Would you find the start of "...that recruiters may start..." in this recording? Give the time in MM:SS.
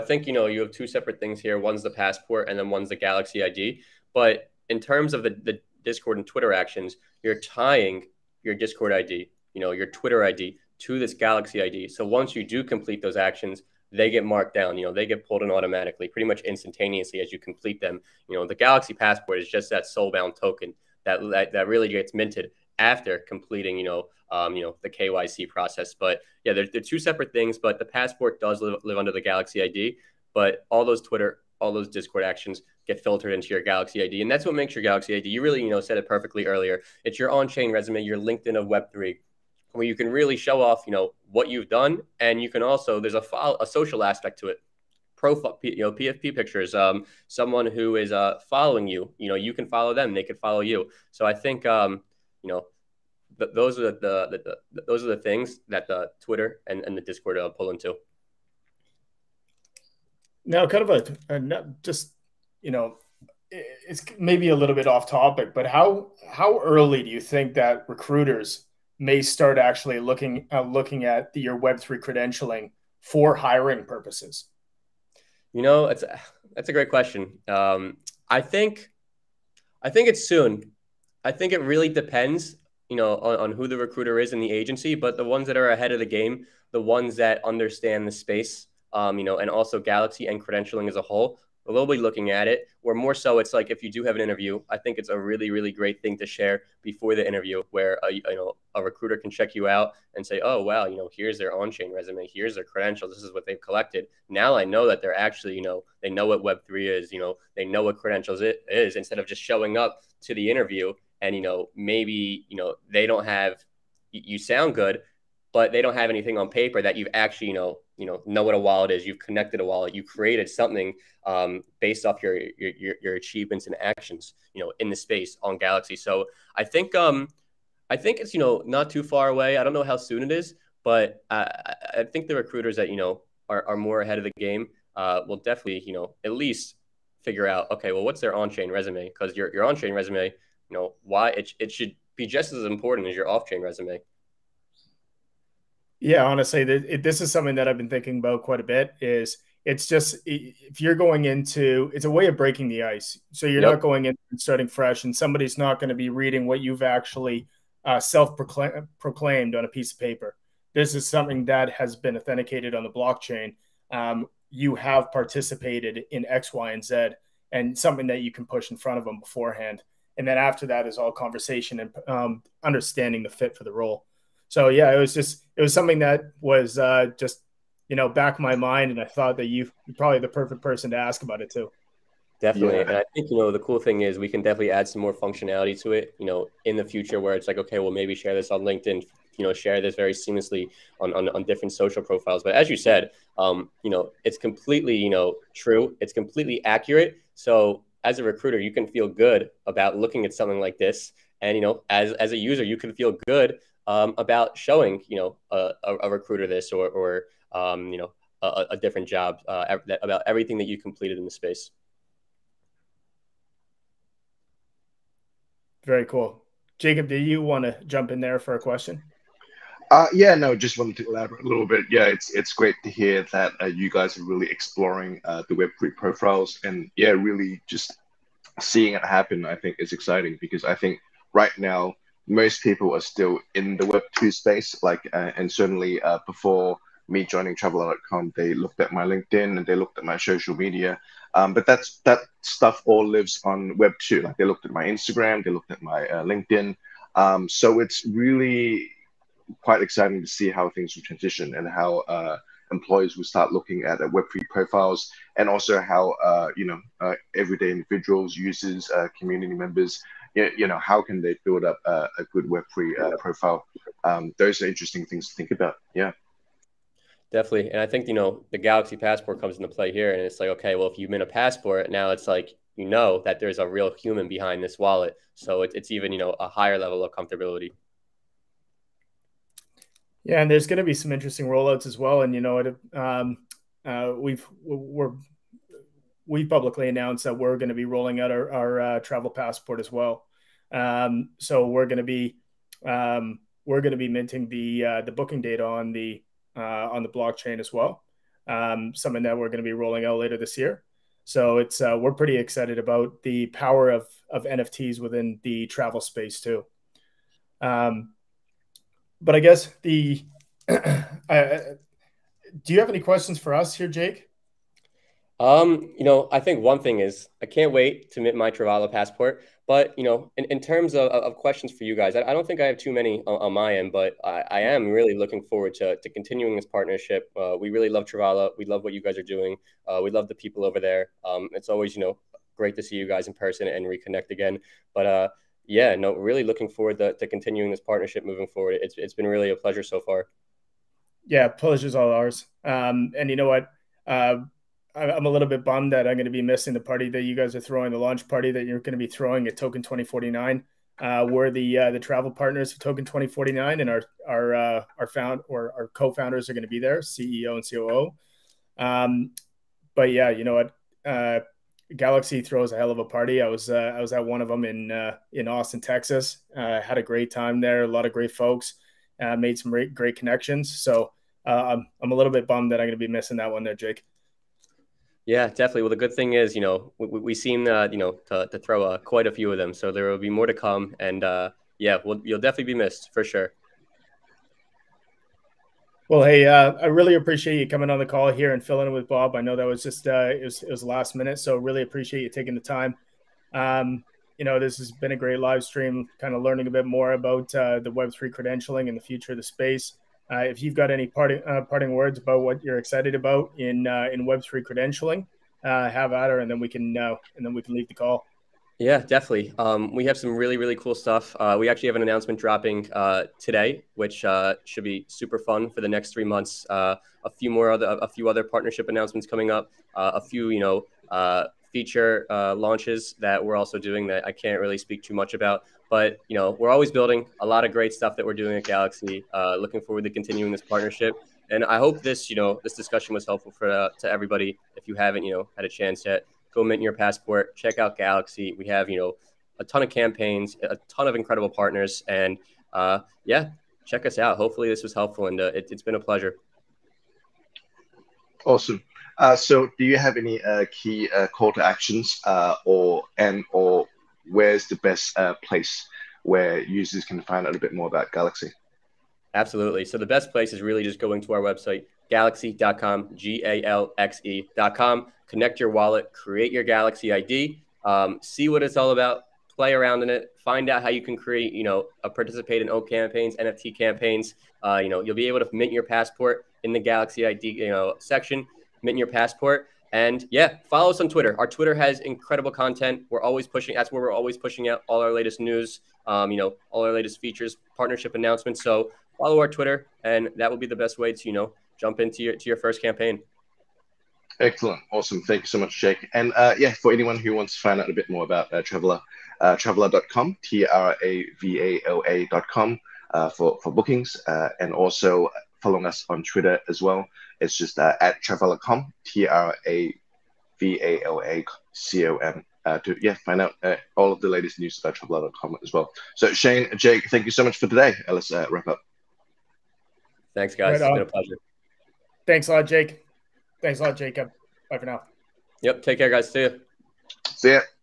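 01:07.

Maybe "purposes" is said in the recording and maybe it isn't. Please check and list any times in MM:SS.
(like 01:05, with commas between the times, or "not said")
01:13.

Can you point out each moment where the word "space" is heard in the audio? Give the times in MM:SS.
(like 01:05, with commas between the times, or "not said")
01:28, 02:04, 03:31, 03:54, 05:06, 06:39.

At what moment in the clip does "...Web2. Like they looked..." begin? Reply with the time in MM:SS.
04:03.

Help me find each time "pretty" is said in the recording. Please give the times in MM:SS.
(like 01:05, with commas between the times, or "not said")
00:16, 05:02.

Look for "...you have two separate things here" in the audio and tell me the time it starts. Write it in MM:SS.
00:00.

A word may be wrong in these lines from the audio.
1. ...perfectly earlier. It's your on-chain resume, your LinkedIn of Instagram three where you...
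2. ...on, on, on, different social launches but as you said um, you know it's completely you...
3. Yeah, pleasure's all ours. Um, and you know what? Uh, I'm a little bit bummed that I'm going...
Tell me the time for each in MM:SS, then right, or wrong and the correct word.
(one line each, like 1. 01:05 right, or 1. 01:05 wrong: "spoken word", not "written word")
1. 00:36 wrong: "Web", not "Instagram"
2. 03:11 wrong: "profiles", not "launches"
3. 05:41 right.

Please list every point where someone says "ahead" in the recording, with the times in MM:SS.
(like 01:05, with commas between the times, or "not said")
01:25, 02:14.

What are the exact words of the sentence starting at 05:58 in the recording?
Um, but yeah, you know what?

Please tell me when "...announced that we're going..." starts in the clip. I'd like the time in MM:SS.
04:46.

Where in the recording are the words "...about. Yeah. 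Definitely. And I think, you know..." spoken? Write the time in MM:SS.
04:25.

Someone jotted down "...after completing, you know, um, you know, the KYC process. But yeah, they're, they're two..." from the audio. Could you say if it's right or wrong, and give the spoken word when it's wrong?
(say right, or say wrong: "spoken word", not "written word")
right.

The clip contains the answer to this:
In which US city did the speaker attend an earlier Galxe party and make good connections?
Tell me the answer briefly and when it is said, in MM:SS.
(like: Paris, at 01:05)
Austin, Texas, at 06:05.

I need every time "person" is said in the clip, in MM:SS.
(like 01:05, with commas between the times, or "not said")
03:00, 05:33.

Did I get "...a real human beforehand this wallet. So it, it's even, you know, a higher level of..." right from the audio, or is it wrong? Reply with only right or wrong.
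wrong.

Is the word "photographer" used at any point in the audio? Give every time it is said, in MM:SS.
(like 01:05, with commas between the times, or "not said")
not said.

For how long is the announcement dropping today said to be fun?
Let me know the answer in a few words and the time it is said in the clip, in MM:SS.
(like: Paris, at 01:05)
3 months, at 06:56.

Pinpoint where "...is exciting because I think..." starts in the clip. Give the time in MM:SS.
03:49.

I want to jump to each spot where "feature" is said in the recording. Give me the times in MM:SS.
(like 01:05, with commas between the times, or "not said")
07:01, 08:07.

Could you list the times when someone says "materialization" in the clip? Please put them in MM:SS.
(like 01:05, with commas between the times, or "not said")
not said.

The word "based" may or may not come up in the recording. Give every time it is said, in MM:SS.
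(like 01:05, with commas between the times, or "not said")
02:01.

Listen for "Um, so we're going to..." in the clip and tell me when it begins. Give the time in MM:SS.
04:50.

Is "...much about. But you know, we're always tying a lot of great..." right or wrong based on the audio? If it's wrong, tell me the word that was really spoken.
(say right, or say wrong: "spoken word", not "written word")
wrong: "building", not "tying".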